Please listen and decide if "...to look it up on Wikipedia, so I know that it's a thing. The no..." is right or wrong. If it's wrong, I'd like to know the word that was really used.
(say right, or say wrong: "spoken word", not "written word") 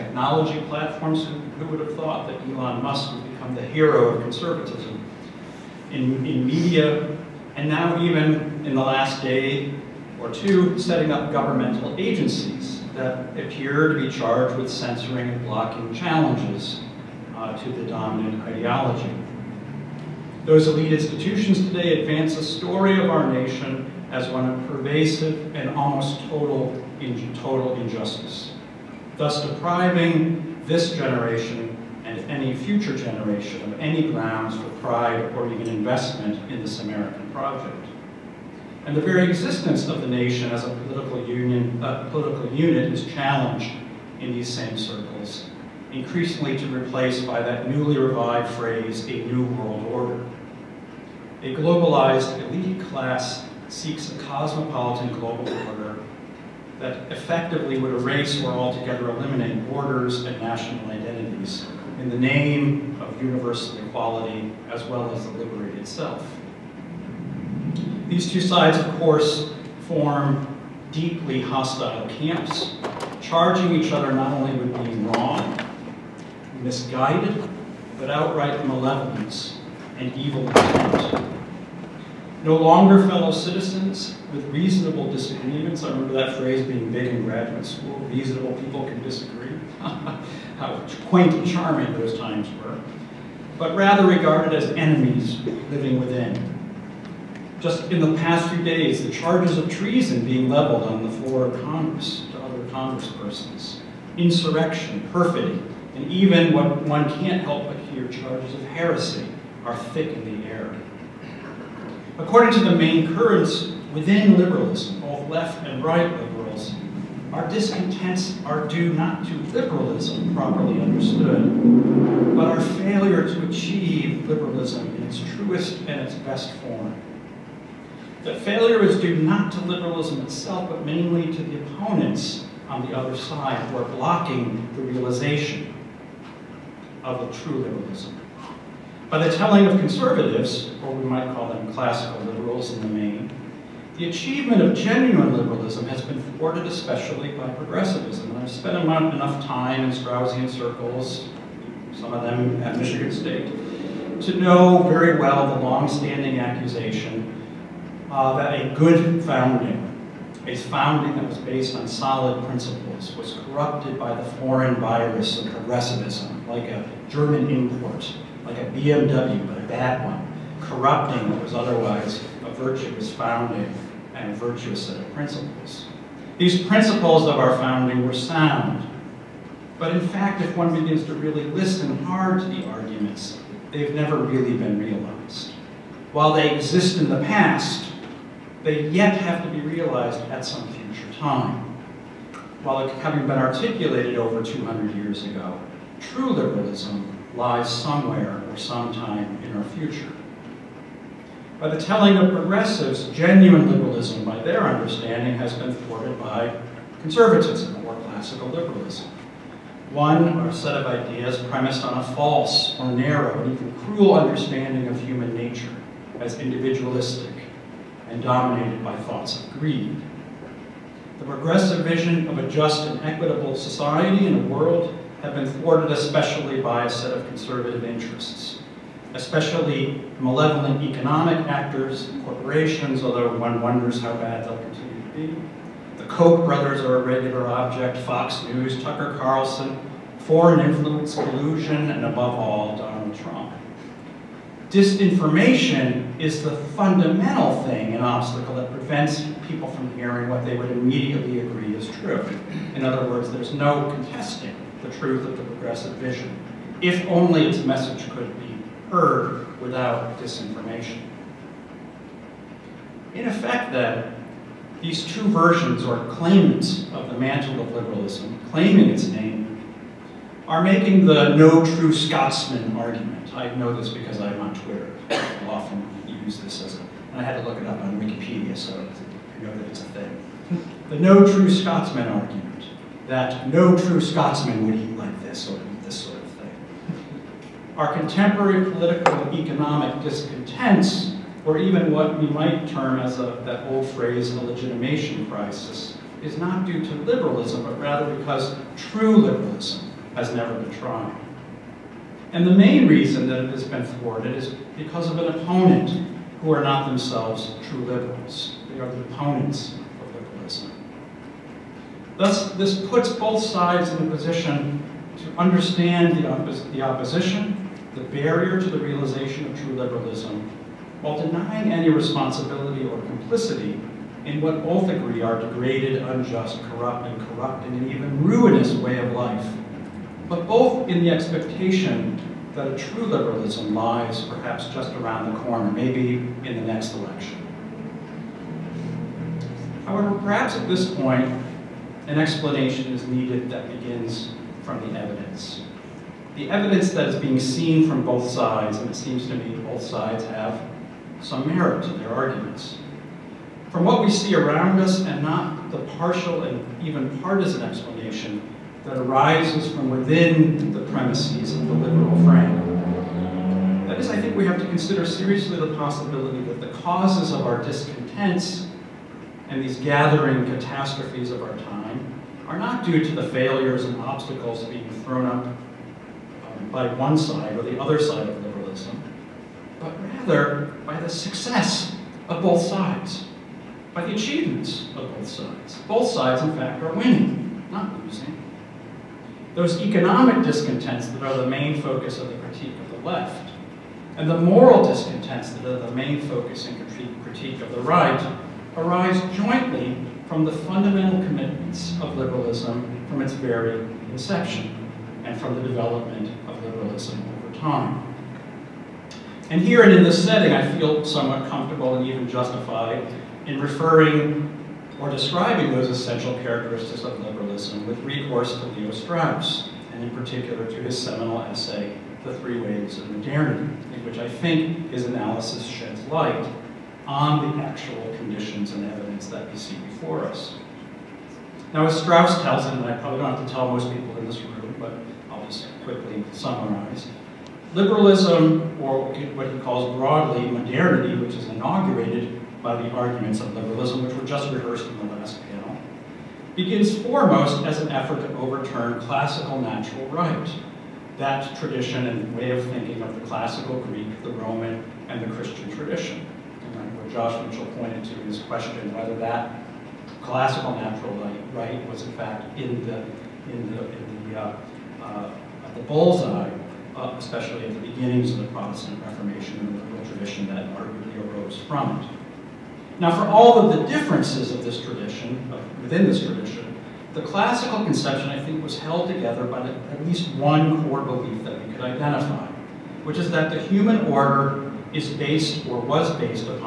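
right.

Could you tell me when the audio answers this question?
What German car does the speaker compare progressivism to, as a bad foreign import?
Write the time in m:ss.
2:48.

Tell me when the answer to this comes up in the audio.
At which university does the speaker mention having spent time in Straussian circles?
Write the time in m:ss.
2:32.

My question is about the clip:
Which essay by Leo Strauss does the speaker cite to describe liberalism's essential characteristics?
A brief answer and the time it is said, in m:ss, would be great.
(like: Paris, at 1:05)
The Three Waves of Modernity, at 7:02.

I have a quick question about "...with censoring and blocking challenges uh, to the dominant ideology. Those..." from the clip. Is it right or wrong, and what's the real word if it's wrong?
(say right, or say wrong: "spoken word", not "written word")
right.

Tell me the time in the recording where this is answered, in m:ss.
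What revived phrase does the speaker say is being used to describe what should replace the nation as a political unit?
0:49.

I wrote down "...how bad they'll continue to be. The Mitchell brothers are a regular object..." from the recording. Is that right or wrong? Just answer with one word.
wrong.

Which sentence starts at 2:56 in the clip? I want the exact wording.
These principles of our founding were sound.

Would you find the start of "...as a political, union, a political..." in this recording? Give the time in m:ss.
0:40.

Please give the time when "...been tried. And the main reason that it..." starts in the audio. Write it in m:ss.
5:00.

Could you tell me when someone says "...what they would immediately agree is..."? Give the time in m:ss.
4:10.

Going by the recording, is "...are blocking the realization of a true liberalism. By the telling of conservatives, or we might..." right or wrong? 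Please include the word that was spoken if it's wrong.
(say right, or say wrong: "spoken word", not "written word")
right.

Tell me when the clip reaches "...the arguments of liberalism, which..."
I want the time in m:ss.
7:22.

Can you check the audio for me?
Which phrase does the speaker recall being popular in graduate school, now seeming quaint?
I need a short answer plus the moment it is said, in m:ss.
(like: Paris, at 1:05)
reasonable people can disagree, at 1:28.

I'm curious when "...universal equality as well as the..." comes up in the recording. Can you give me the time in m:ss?
1:03.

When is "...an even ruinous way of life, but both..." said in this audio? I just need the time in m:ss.
5:27.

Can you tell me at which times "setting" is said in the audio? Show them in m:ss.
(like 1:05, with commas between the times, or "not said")
0:10, 6:50.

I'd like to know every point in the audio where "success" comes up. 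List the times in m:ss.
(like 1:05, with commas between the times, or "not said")
6:21.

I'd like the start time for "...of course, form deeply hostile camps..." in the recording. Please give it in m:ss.
1:08.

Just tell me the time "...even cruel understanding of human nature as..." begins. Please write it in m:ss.
3:33.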